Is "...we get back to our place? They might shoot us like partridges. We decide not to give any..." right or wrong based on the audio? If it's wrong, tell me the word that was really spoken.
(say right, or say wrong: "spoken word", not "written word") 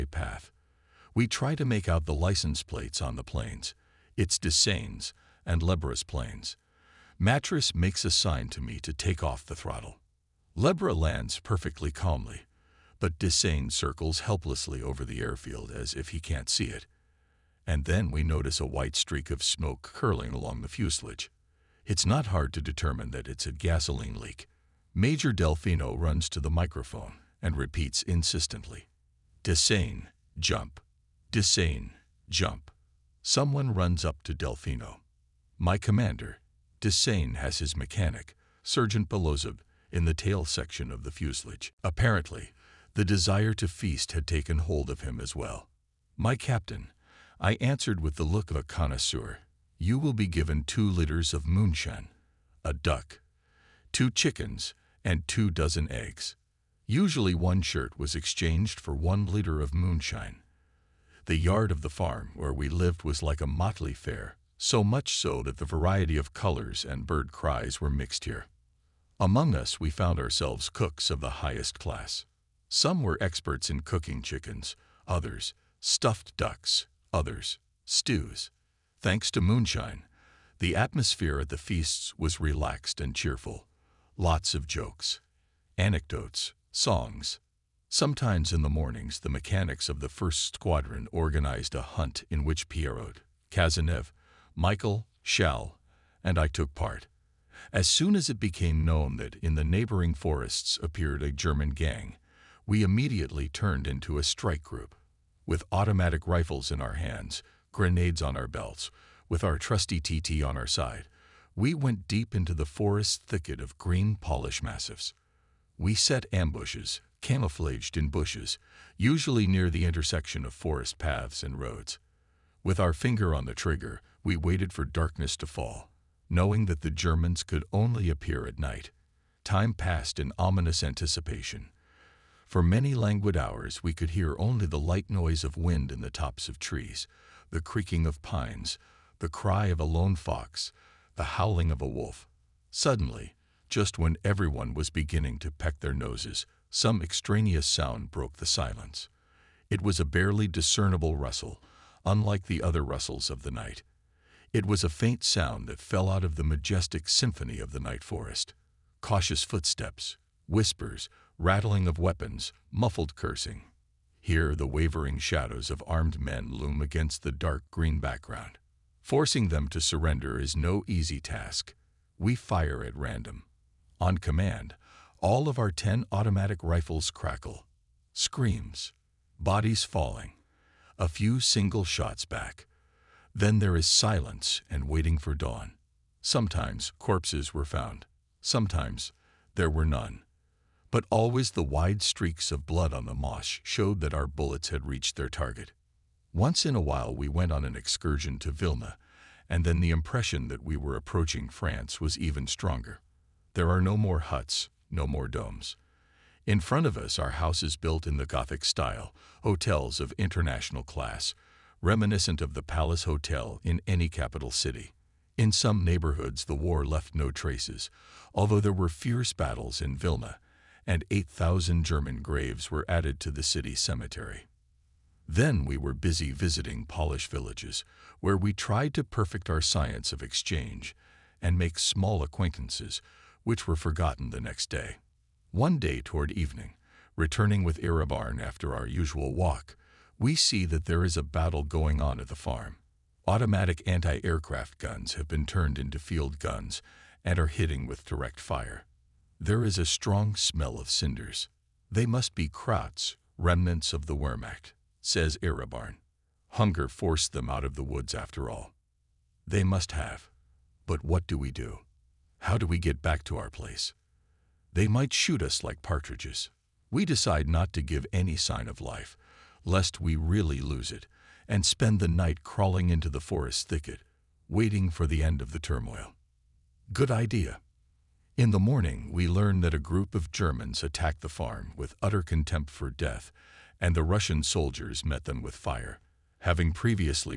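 right.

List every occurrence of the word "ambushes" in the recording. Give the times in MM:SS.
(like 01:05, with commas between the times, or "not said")
01:56.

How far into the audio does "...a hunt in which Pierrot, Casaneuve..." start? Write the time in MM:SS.
01:31.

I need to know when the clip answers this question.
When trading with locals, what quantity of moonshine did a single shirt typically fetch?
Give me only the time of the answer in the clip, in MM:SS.
00:58.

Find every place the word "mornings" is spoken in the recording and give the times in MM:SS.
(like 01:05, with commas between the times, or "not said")
01:28, 04:38.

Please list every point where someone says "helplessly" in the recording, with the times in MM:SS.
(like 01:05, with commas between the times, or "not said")
00:14.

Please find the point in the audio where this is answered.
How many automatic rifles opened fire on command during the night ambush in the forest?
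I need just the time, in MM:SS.
02:55.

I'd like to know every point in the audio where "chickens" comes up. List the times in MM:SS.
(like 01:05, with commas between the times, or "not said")
00:54, 01:14.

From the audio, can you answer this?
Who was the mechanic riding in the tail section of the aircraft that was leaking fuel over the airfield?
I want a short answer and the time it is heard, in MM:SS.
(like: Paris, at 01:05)
Sergeant Belozov, at 00:38.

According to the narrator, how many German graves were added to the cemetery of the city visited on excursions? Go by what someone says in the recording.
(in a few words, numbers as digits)
8,000.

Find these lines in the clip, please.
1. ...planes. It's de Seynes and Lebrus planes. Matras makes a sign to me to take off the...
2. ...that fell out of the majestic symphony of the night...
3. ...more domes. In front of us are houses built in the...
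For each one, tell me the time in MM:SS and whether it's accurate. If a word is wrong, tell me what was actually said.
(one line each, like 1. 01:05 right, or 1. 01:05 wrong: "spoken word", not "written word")
1. 00:03 right
2. 02:35 right
3. 03:25 right.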